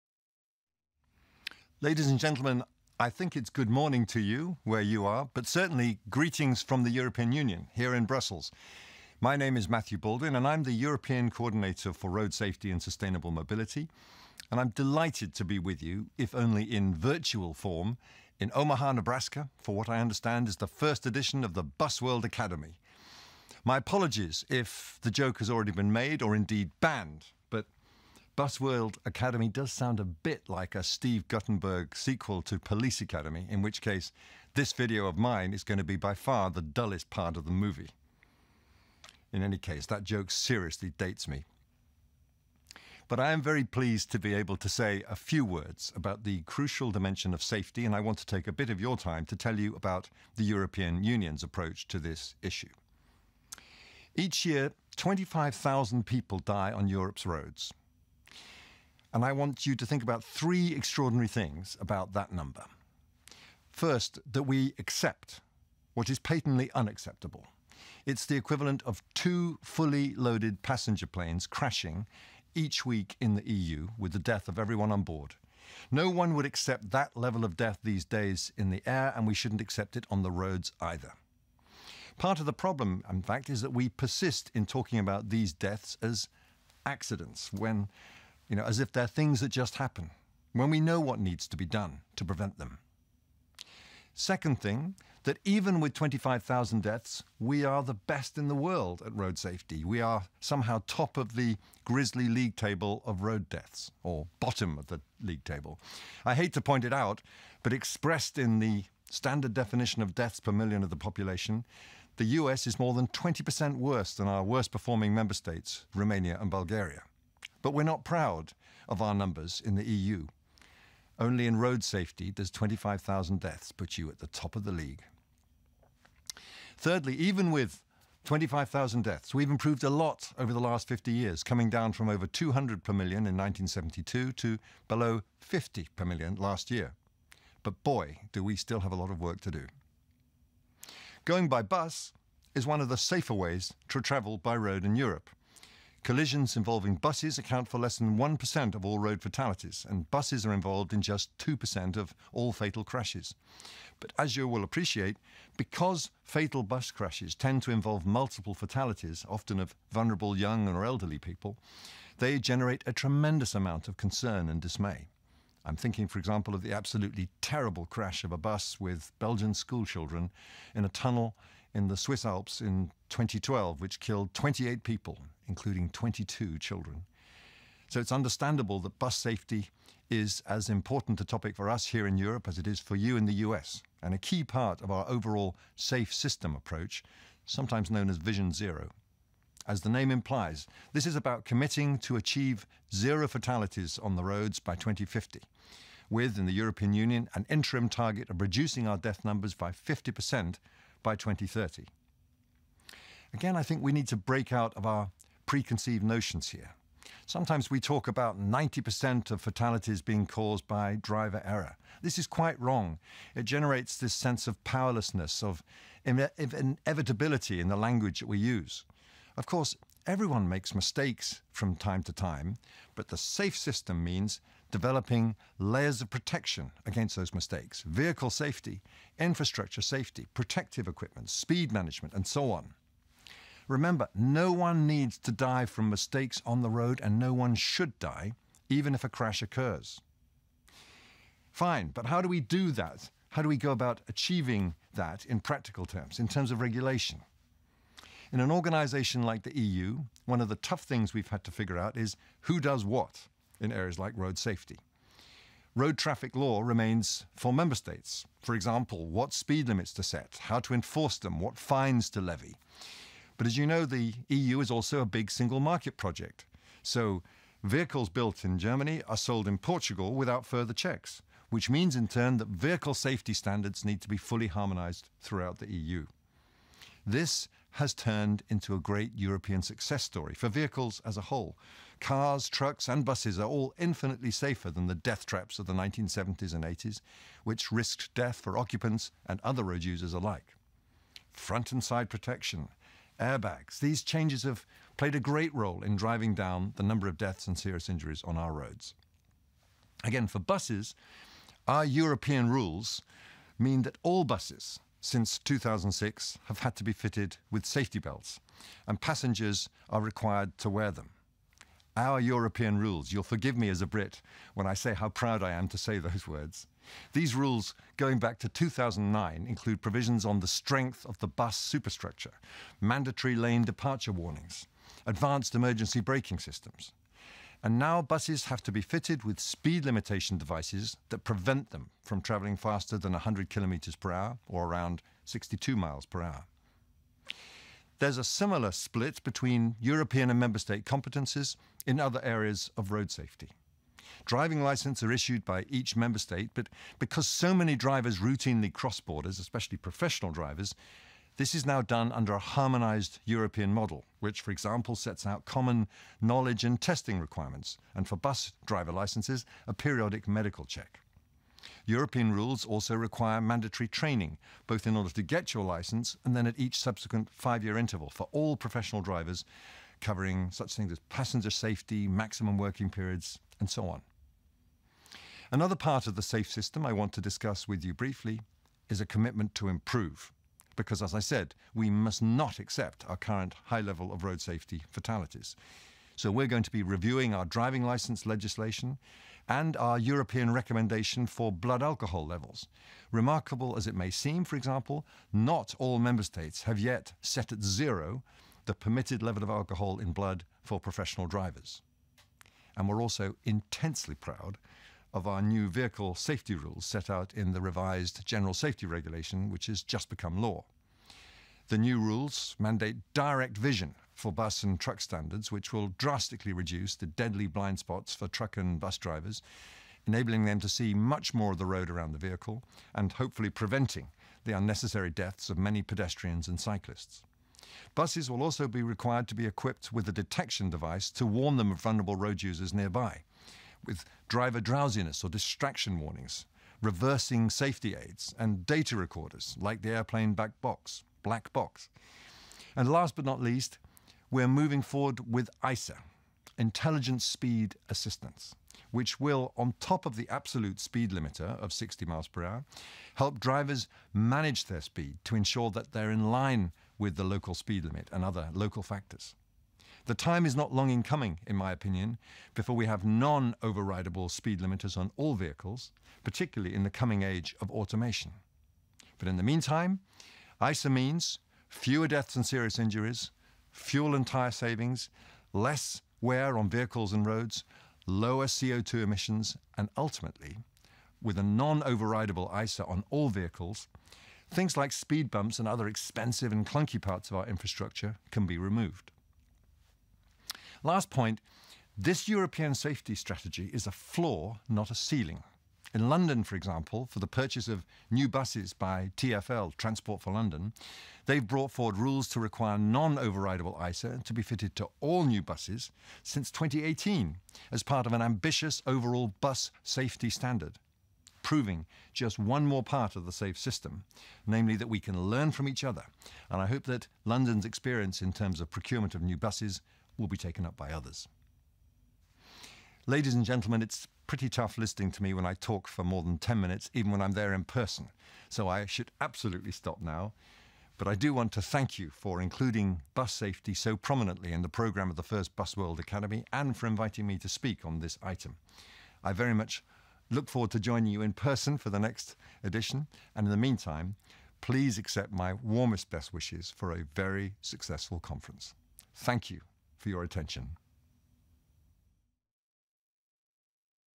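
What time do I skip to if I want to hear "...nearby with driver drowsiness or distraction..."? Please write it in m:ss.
7:12.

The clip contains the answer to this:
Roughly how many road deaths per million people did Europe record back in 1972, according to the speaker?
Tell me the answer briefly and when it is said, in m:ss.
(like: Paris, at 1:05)
over 200, at 2:12.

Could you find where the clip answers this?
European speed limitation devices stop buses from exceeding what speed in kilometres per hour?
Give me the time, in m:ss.
5:33.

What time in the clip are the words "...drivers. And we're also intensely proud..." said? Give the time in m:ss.
6:41.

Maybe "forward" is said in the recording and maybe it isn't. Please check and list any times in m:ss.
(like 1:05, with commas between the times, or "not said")
7:24, 8:21, 9:00.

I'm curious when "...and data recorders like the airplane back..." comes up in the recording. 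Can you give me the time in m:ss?
7:18.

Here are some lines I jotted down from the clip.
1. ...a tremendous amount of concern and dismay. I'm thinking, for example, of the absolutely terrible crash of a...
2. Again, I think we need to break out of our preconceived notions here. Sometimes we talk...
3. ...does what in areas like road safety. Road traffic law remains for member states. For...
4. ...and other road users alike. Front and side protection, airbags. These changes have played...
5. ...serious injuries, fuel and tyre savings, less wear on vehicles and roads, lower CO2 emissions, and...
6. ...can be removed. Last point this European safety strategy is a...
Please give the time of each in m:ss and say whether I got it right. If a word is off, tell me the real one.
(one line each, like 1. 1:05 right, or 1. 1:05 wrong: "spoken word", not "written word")
1. 2:42 right
2. 3:23 right
3. 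4:12 right
4. 4:49 right
5. 7:52 right
6. 8:08 right.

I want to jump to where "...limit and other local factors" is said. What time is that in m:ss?
7:37.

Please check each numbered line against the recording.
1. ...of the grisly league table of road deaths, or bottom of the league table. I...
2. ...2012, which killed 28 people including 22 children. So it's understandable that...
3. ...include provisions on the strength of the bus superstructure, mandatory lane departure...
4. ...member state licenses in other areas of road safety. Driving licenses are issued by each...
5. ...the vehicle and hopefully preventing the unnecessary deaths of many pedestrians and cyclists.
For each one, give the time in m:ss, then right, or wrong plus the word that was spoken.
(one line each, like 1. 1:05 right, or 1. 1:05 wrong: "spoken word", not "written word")
1. 1:41 right
2. 2:53 right
3. 5:19 right
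4. 5:40 wrong: "competences", not "licenses"
5. 7:02 right.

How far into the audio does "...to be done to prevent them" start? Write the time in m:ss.
1:31.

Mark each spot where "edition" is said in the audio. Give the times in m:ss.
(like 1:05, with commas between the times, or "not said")
0:21, 9:02.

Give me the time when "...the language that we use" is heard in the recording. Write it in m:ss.
3:37.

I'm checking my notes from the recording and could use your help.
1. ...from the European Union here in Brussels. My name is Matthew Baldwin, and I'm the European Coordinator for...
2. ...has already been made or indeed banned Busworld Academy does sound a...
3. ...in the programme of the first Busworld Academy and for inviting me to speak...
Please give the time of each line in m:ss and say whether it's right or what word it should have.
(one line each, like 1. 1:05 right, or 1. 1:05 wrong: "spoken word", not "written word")
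1. 0:06 right
2. 0:25 right
3. 8:54 right.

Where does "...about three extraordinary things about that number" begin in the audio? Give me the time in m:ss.
1:00.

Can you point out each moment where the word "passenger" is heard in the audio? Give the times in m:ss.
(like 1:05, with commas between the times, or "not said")
1:10, 5:09, 6:11.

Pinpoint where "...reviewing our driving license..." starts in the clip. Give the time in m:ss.
6:26.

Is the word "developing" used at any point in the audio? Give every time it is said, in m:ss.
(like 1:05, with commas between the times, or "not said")
3:44.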